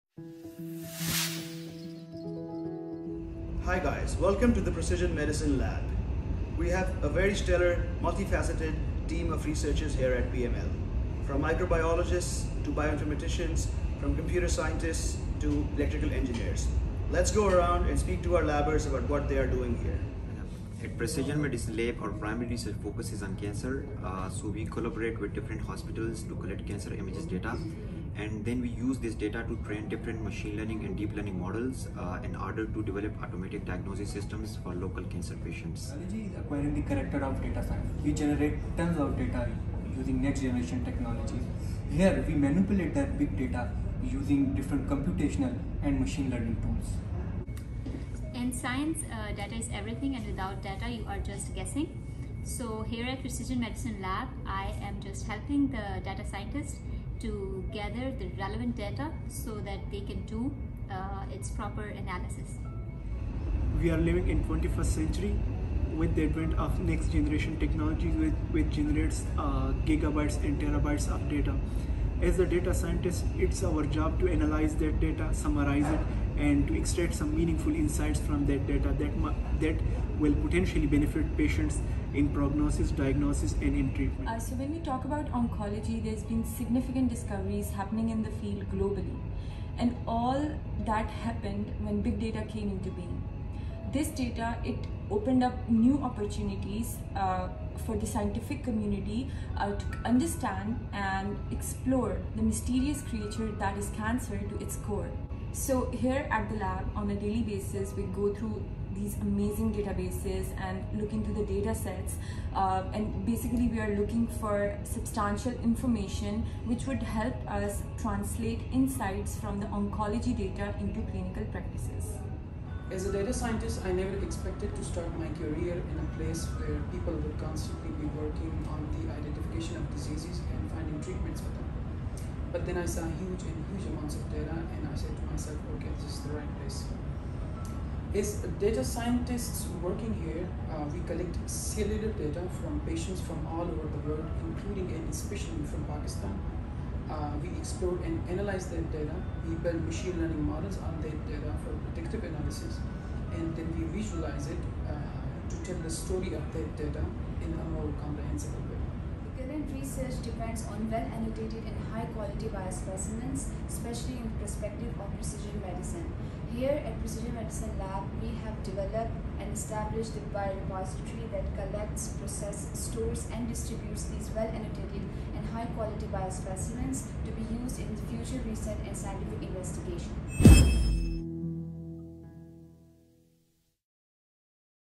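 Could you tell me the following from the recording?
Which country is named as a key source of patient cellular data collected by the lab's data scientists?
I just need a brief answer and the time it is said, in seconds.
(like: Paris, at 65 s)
Pakistan, at 145 s.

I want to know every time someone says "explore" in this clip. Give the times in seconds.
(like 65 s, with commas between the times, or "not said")
101 s, 147 s.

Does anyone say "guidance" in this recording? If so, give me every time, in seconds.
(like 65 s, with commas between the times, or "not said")
not said.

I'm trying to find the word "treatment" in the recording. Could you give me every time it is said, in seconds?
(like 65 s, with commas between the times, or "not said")
83 s, 130 s.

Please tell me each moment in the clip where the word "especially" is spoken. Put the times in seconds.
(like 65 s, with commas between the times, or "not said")
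145 s, 163 s.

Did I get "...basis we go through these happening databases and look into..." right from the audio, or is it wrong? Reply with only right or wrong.
wrong.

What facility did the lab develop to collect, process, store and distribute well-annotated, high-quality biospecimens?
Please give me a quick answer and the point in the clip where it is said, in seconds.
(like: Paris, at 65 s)
Biorepository, at 170 s.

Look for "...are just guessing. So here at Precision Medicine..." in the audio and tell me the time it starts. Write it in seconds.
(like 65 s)
51 s.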